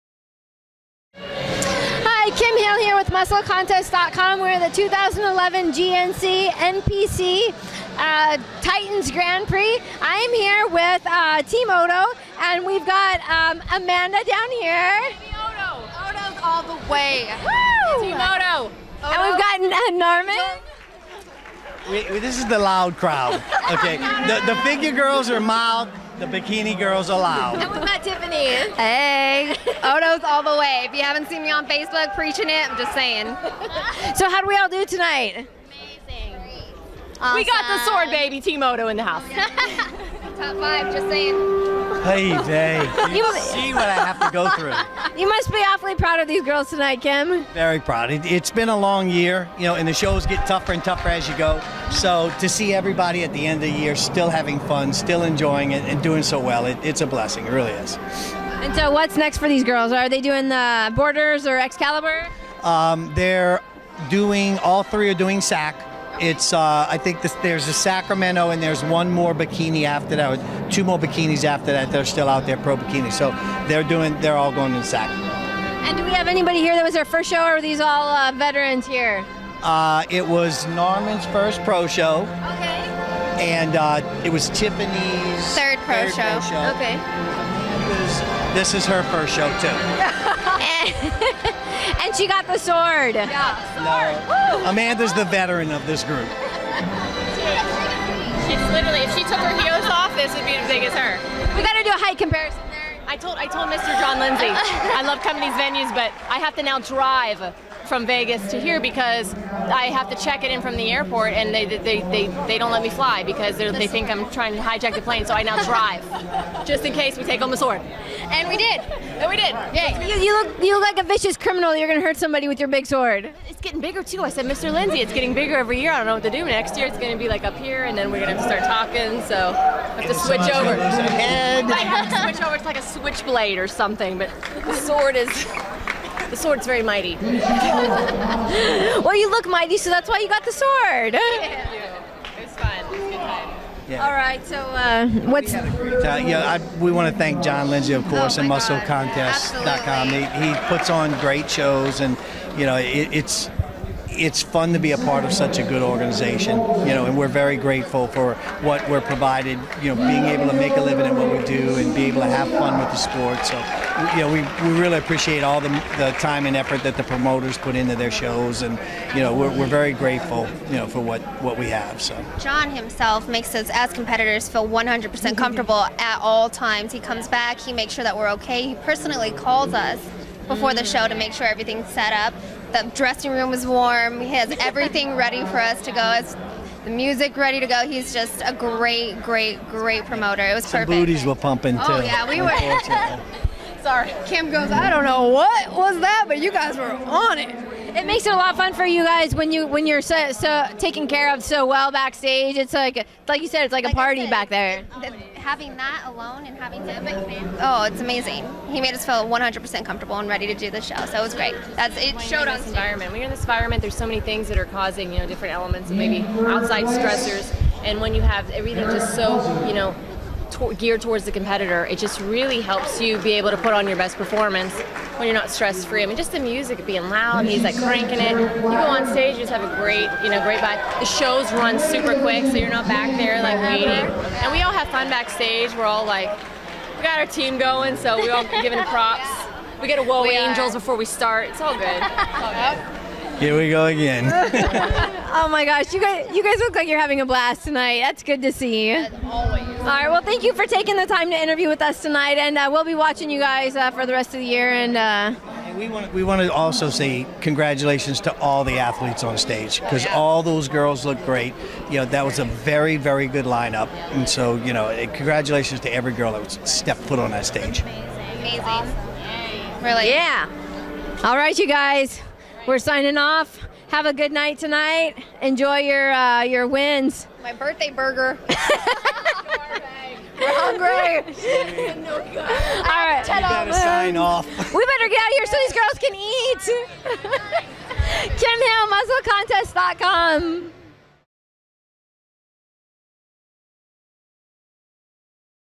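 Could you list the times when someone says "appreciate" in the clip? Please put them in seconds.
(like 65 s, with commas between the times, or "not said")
164 s.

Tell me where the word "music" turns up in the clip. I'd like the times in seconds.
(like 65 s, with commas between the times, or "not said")
186 s, 226 s.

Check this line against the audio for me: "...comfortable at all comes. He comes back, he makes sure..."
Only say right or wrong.
wrong.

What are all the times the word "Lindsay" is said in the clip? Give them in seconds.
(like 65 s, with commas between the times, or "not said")
104 s, 124 s, 147 s.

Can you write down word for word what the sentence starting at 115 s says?
So I now drive, just in case we take home the sword.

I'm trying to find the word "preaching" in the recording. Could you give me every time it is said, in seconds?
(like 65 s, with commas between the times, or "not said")
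32 s.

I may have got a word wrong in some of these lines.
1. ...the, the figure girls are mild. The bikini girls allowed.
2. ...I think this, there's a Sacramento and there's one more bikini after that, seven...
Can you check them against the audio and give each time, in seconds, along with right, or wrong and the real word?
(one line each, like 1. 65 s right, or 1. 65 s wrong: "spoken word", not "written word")
1. 23 s right
2. 66 s wrong: "two", not "seven".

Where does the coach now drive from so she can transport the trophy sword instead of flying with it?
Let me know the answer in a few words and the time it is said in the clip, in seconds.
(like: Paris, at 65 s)
Vegas, at 108 s.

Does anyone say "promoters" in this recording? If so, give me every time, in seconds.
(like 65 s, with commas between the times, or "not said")
167 s, 190 s.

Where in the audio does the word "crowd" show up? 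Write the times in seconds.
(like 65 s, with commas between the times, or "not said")
22 s.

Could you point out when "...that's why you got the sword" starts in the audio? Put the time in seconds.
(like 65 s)
139 s.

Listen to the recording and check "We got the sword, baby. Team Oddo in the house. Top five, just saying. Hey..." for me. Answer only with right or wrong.
right.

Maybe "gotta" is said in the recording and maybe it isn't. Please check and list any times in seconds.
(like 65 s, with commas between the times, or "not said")
101 s, 283 s.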